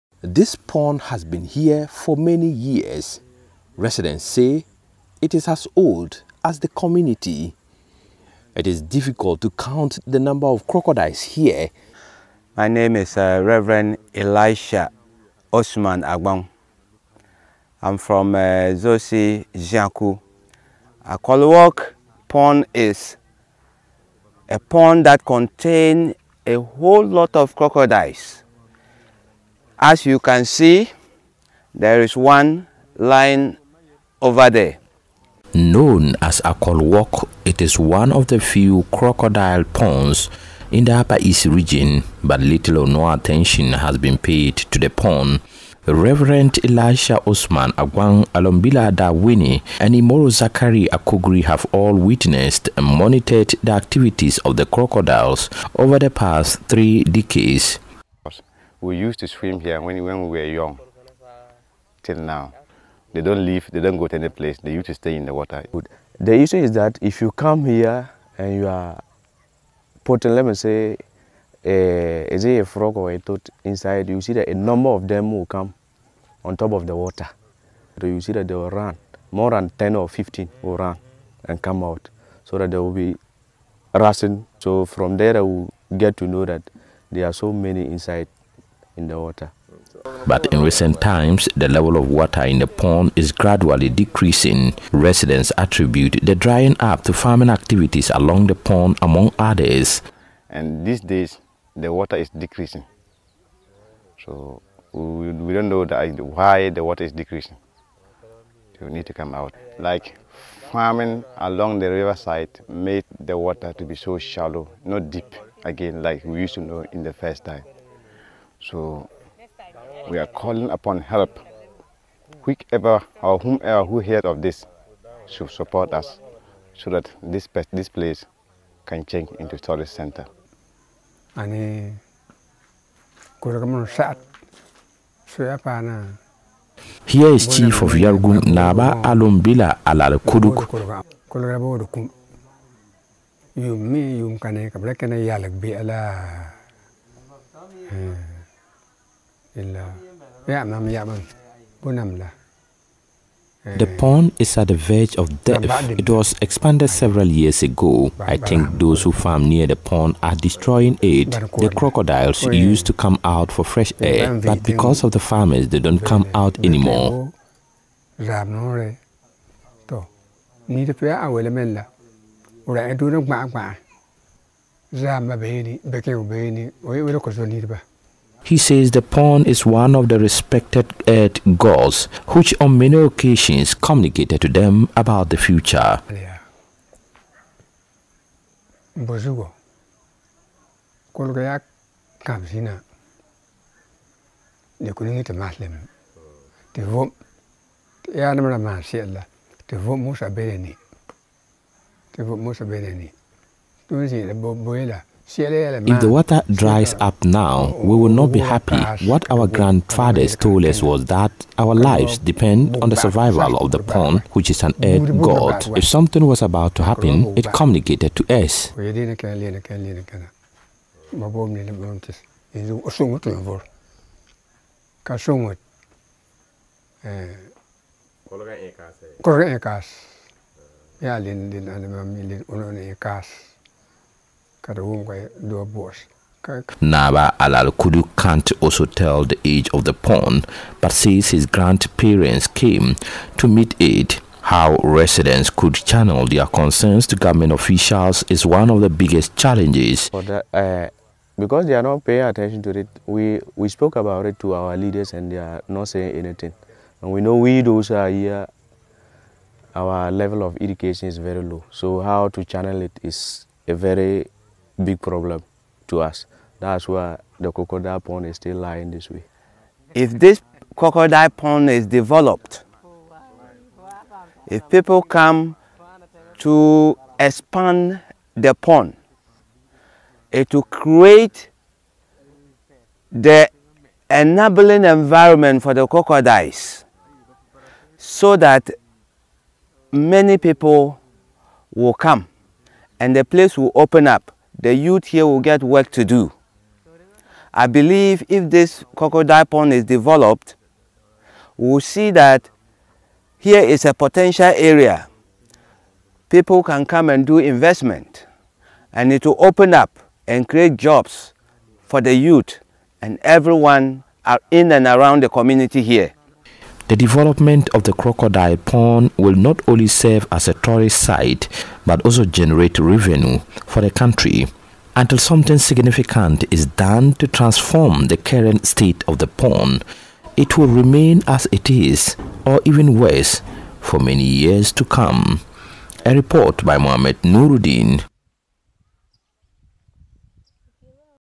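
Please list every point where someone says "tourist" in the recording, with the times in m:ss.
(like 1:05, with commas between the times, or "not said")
2:09, 5:20.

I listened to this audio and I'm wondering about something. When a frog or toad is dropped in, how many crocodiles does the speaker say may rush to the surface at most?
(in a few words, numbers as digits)
15.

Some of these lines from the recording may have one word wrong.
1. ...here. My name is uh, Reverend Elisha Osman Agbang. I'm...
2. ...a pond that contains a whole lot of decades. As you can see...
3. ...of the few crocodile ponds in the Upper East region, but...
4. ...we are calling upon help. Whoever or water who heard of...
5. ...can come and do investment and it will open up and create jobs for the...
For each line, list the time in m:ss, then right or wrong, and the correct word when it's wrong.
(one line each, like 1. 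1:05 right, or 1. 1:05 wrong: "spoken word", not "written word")
1. 0:11 right
2. 0:24 wrong: "crocodiles", not "decades"
3. 0:38 right
4. 2:00 wrong: "whomever", not "water"
5. 5:06 right.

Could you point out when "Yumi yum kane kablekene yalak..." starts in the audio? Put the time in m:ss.
2:23.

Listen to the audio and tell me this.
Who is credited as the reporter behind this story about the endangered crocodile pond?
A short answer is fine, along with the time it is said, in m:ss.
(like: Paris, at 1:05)
Mohamed Nurudeen, at 5:36.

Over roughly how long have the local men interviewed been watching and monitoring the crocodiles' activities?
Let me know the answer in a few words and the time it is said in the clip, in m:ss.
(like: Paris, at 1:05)
three decades, at 0:56.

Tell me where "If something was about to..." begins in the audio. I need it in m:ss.
3:35.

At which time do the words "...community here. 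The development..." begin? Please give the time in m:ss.
5:15.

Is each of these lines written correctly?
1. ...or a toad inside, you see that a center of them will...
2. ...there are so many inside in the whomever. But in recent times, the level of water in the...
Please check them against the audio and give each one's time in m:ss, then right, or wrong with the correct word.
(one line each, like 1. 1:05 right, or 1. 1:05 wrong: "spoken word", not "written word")
1. 1:12 wrong: "number", not "center"
2. 1:27 wrong: "water", not "whomever".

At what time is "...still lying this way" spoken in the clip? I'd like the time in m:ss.
4:28.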